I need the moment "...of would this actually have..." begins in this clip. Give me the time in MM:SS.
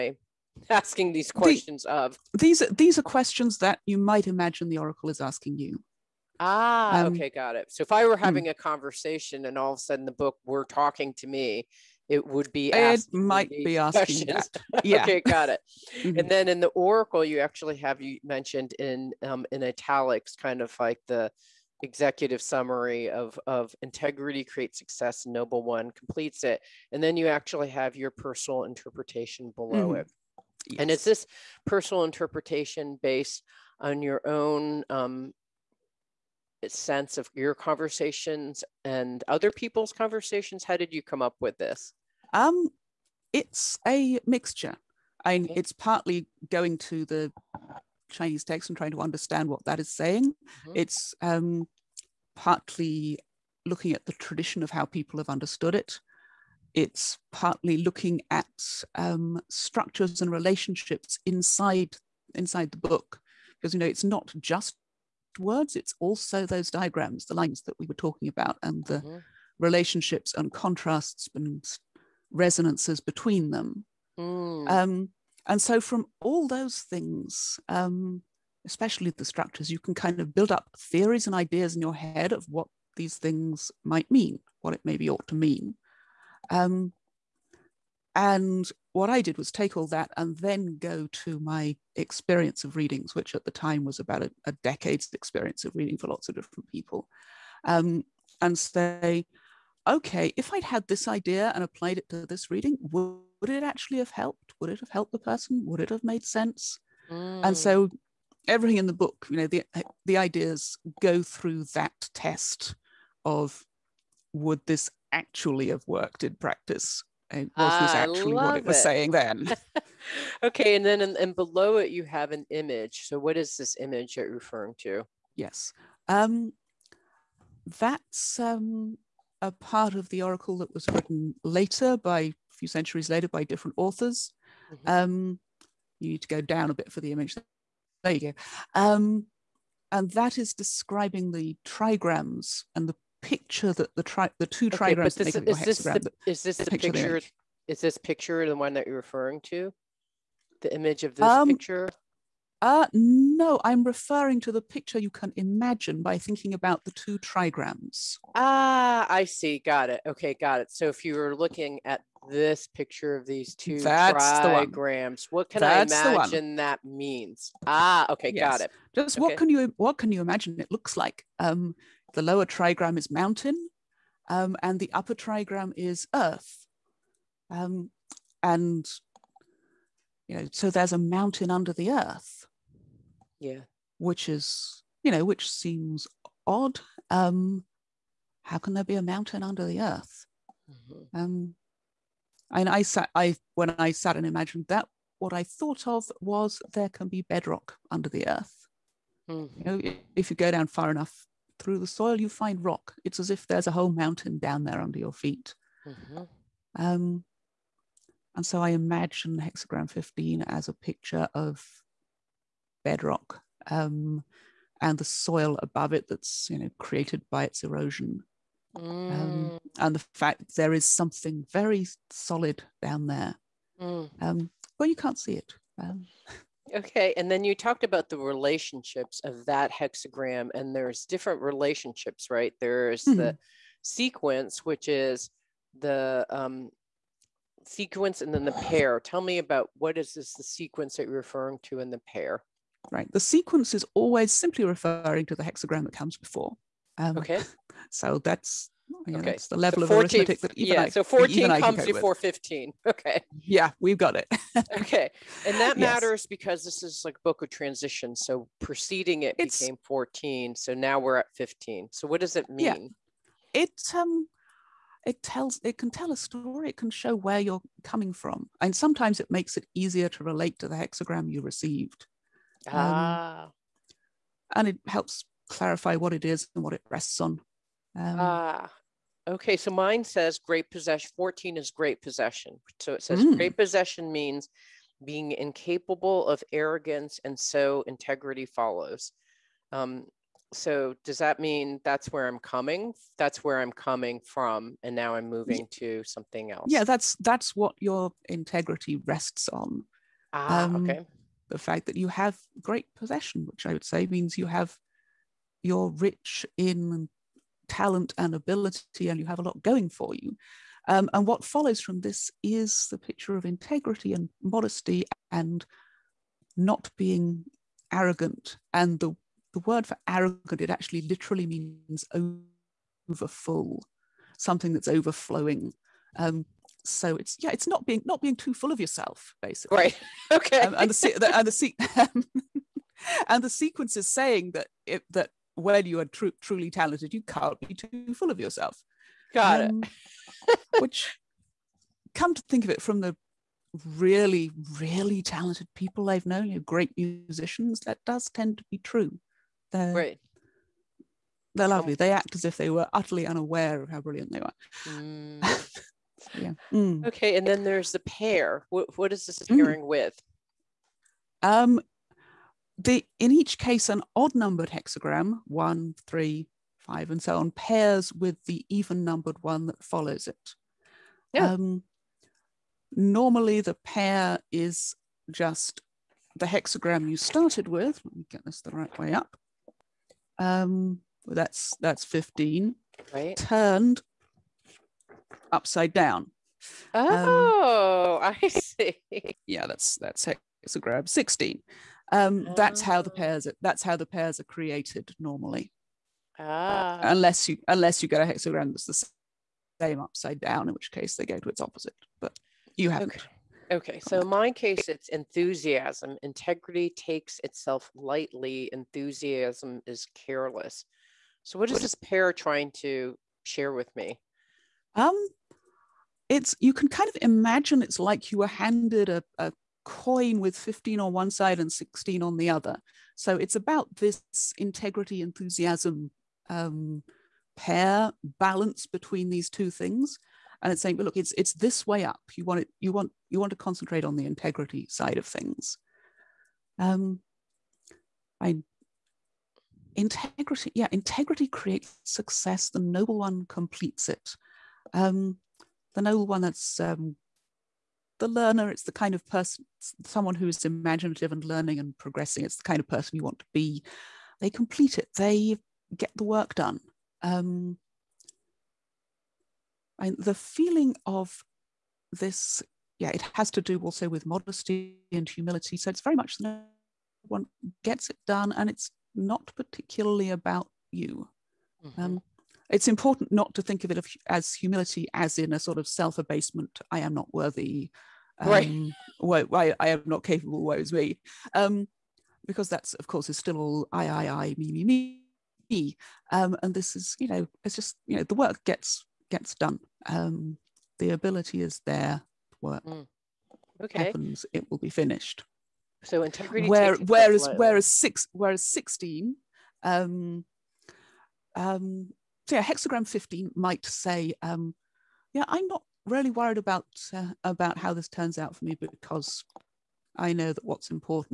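01:53.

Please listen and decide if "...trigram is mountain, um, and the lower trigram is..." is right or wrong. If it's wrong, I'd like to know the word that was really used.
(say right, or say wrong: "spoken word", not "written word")
wrong: "upper", not "lower".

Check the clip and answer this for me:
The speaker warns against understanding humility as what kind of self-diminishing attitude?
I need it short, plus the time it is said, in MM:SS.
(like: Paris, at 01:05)
Self abasement, at 07:55.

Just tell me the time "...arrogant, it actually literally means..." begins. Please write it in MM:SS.
05:20.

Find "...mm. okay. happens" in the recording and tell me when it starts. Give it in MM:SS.
08:12.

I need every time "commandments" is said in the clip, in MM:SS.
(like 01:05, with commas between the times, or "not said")
not said.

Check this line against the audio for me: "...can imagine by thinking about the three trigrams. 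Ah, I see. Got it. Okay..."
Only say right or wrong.
wrong.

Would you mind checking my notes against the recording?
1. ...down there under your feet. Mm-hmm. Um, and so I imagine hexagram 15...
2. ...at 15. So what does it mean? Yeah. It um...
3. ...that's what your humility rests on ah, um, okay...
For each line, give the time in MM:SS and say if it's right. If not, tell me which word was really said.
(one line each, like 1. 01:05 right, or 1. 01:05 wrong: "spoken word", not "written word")
1. 03:24 right
2. 04:21 right
3. 04:57 wrong: "integrity", not "humility".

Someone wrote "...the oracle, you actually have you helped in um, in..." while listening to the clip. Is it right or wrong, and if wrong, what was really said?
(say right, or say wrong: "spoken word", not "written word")
wrong: "mentioned", not "helped".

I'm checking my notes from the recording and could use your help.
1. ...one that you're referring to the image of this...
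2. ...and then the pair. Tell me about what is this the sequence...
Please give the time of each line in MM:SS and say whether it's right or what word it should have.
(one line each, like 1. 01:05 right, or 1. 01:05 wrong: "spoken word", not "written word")
1. 02:28 right
2. 03:58 right.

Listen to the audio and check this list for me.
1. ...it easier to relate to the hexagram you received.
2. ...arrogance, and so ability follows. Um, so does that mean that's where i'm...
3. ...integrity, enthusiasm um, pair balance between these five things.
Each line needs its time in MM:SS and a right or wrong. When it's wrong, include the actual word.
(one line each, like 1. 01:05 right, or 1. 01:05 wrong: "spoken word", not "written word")
1. 04:29 right
2. 04:46 wrong: "integrity", not "ability"
3. 07:04 wrong: "two", not "five".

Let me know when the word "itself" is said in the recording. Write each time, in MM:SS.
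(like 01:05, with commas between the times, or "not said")
06:47.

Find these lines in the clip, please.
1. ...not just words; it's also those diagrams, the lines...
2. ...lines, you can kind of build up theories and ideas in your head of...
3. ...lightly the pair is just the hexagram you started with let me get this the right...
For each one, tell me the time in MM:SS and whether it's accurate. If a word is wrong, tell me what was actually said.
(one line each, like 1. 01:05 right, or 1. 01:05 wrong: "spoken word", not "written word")
1. 01:04 right
2. 01:19 wrong: "structures", not "lines"
3. 06:12 wrong: "normally", not "lightly".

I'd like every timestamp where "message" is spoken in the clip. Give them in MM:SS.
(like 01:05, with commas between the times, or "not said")
not said.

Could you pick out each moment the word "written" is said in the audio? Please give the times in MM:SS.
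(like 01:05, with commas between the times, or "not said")
02:10.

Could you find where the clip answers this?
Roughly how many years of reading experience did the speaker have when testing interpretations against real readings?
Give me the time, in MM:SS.
01:34.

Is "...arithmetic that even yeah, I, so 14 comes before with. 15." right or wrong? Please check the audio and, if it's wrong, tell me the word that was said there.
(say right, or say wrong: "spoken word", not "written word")
right.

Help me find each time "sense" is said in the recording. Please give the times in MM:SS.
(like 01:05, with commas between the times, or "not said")
00:36, 01:46.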